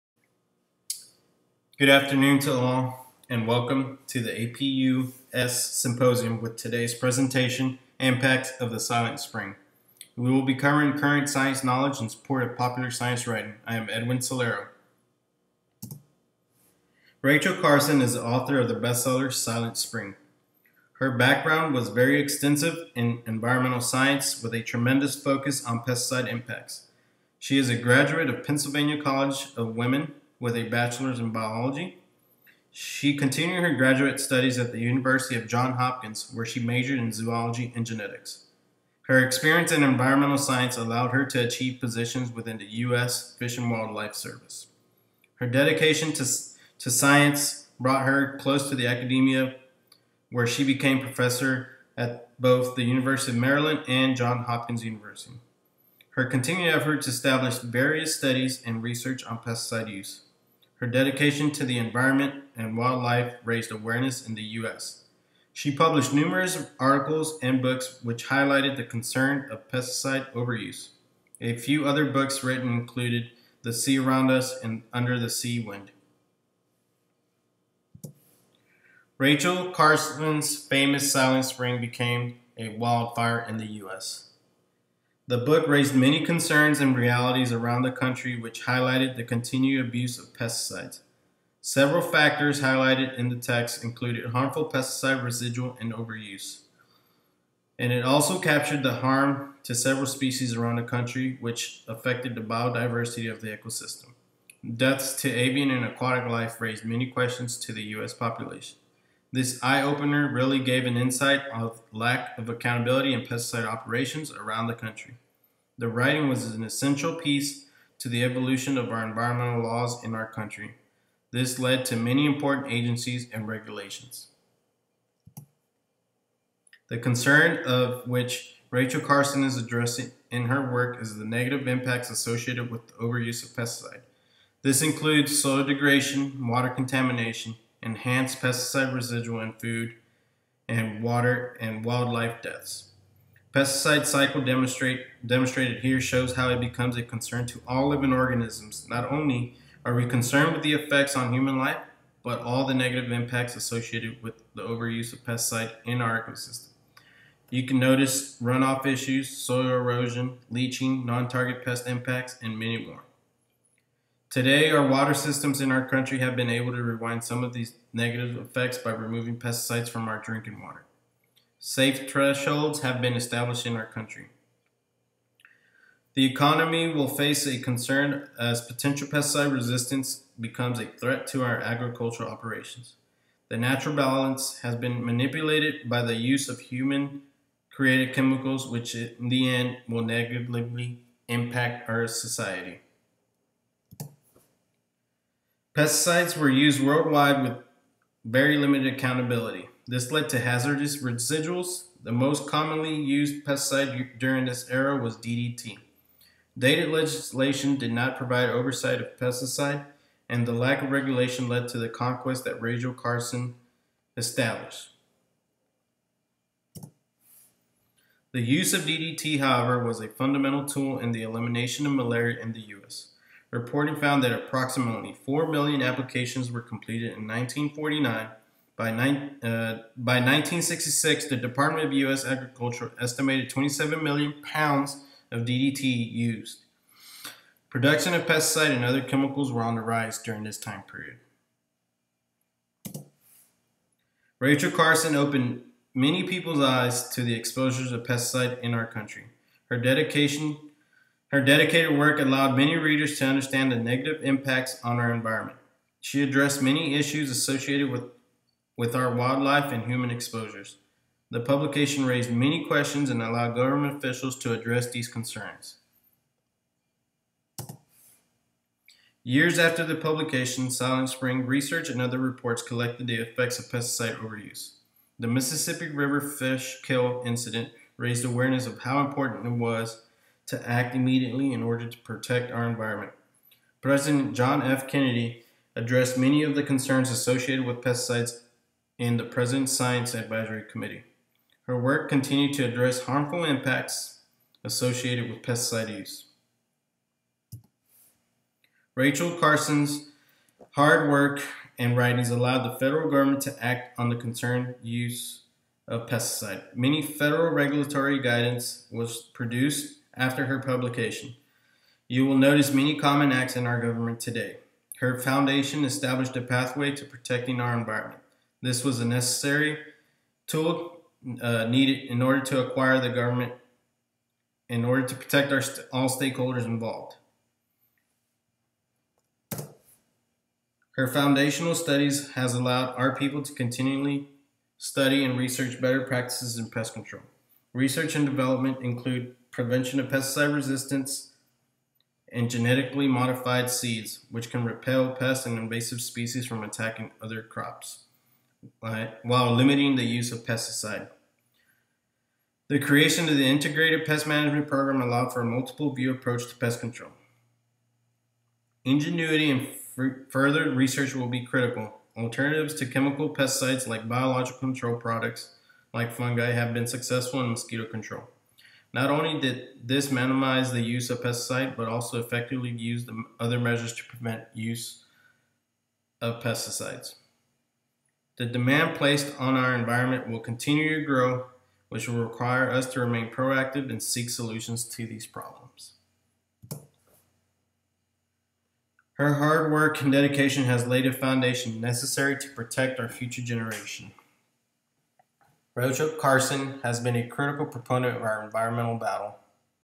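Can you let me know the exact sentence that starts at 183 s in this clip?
The natural balance has been manipulated by the use of human created chemicals, which in the end will negatively impact our society.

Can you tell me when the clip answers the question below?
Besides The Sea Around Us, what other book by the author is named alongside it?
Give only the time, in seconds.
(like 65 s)
74 s.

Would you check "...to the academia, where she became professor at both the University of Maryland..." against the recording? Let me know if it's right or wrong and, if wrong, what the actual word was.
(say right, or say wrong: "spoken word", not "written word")
right.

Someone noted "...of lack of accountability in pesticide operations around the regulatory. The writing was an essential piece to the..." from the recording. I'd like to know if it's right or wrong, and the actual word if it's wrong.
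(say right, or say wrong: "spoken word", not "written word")
wrong: "country", not "regulatory".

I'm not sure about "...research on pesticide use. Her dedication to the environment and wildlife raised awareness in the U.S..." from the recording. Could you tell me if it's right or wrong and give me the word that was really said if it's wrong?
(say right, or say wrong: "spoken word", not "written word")
right.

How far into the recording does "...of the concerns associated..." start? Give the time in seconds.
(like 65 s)
286 s.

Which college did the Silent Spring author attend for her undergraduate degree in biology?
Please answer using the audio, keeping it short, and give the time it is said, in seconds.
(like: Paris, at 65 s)
Pennsylvania College of Women, at 28 s.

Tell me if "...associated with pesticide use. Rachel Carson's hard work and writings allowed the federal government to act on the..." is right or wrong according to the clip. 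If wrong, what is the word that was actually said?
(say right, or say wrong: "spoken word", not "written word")
right.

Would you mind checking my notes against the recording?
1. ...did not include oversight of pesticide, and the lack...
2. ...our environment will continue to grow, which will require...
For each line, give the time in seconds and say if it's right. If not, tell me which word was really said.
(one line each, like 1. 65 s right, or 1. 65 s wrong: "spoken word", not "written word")
1. 207 s wrong: "provide", not "include"
2. 379 s right.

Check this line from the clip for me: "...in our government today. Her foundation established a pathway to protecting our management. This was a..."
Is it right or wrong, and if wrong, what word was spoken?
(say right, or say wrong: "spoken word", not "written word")
wrong: "environment", not "management".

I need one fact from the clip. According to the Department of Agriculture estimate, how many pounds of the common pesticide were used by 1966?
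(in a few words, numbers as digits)
27 million.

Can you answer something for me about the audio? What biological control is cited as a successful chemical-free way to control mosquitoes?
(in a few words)
fungi.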